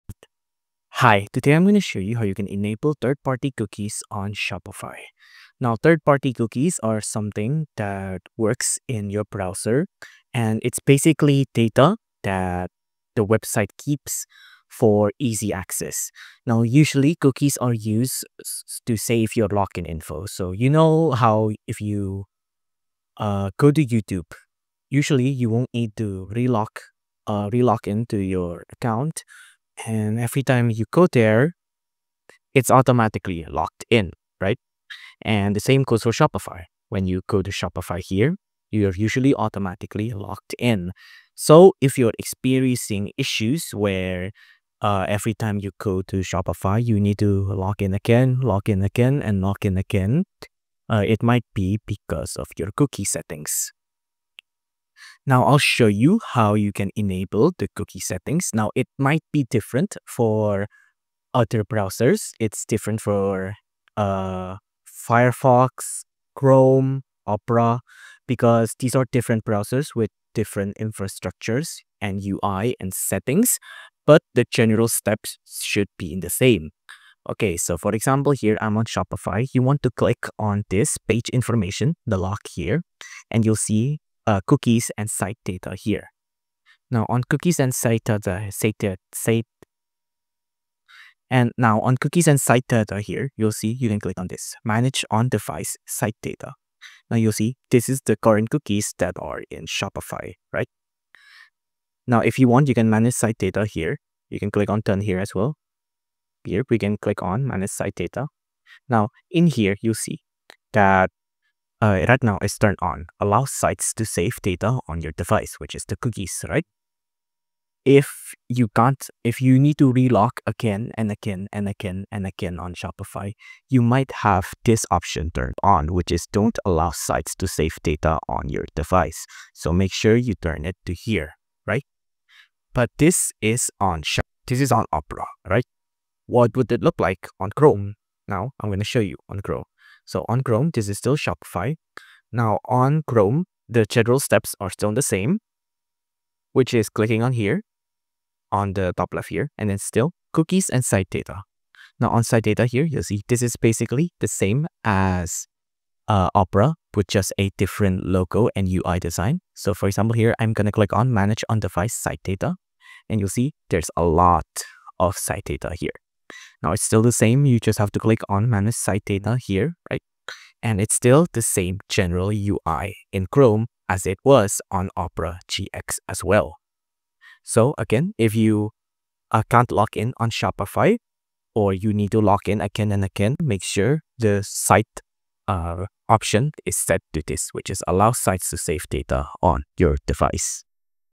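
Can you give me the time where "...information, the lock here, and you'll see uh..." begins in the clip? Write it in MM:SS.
01:21.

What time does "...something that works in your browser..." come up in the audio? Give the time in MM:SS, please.
00:07.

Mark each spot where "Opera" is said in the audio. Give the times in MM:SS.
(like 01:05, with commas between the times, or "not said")
01:07, 02:14, 02:36, 02:54.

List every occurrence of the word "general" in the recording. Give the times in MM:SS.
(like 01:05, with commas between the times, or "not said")
01:14, 02:23, 02:51.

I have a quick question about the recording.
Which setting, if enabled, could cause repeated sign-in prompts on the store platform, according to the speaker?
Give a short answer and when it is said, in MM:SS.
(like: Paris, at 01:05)
Don't allow sites to save data on your device, at 02:06.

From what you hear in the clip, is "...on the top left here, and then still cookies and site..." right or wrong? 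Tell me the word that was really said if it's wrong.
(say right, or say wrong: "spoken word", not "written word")
right.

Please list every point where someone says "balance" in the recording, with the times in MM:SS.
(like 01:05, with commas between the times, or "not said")
not said.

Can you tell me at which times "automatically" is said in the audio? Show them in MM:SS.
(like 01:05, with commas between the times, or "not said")
00:32, 00:39.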